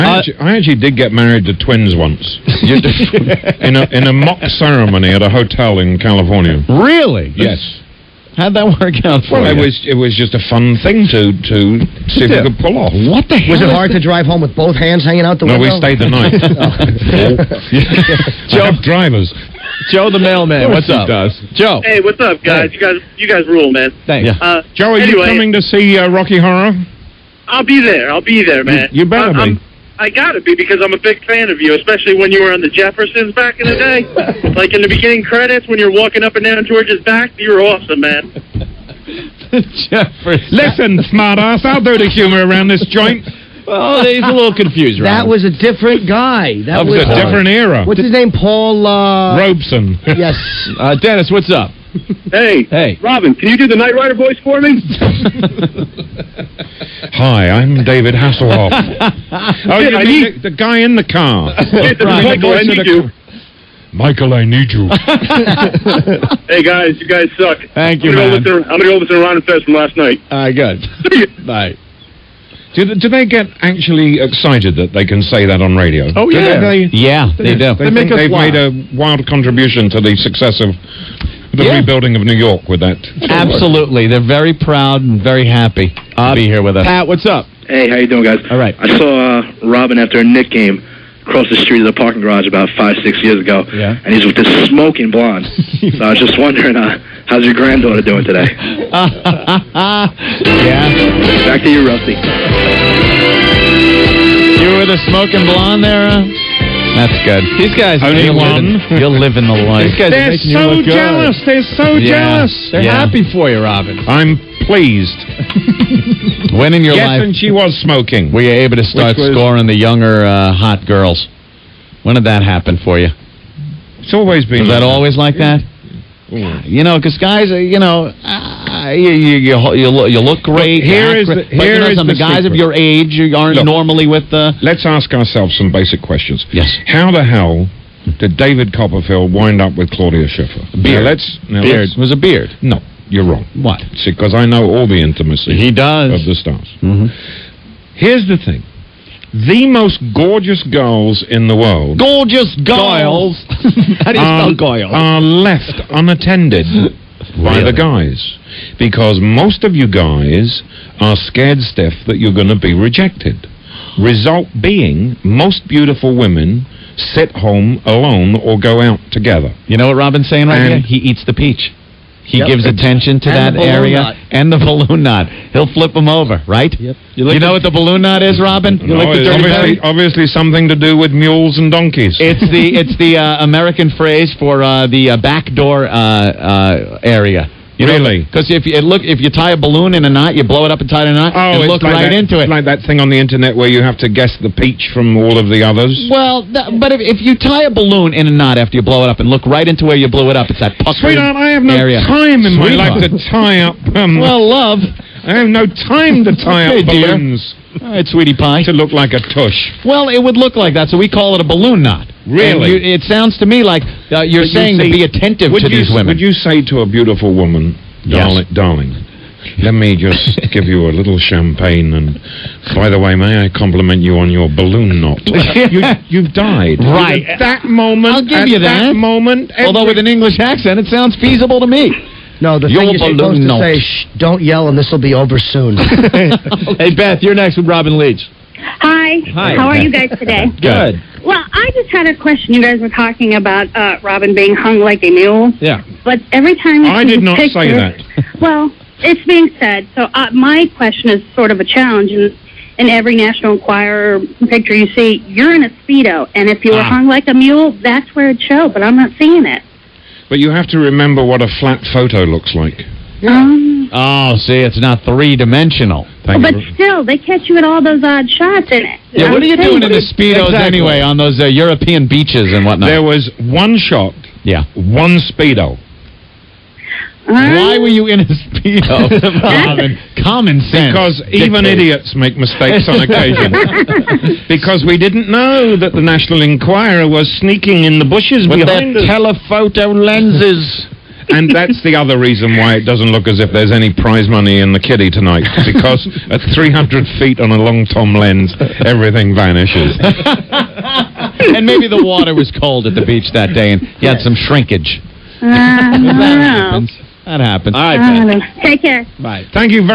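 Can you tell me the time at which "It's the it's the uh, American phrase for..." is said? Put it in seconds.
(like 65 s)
182 s.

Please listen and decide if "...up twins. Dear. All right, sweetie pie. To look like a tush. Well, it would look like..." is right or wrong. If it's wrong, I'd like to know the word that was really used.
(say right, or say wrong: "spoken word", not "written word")
wrong: "balloons", not "twins".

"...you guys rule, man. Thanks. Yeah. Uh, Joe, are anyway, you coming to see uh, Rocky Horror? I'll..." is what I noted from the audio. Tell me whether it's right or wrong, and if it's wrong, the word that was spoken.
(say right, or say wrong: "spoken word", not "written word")
right.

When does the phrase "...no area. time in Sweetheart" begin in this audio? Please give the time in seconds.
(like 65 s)
201 s.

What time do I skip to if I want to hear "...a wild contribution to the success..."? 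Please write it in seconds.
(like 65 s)
78 s.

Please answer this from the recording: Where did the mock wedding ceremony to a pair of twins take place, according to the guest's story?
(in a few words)
California.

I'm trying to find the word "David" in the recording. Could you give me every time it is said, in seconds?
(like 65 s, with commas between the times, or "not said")
57 s, 138 s.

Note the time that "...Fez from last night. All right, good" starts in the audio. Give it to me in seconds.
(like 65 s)
69 s.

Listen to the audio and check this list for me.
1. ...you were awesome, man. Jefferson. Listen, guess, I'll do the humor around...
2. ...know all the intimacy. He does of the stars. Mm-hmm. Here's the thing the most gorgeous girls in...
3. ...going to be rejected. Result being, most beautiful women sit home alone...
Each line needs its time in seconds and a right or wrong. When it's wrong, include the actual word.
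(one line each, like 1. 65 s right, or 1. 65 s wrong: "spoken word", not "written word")
1. 37 s wrong: "smartass", not "guess"
2. 144 s right
3. 162 s right.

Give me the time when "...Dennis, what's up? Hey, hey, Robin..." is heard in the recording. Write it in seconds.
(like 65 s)
50 s.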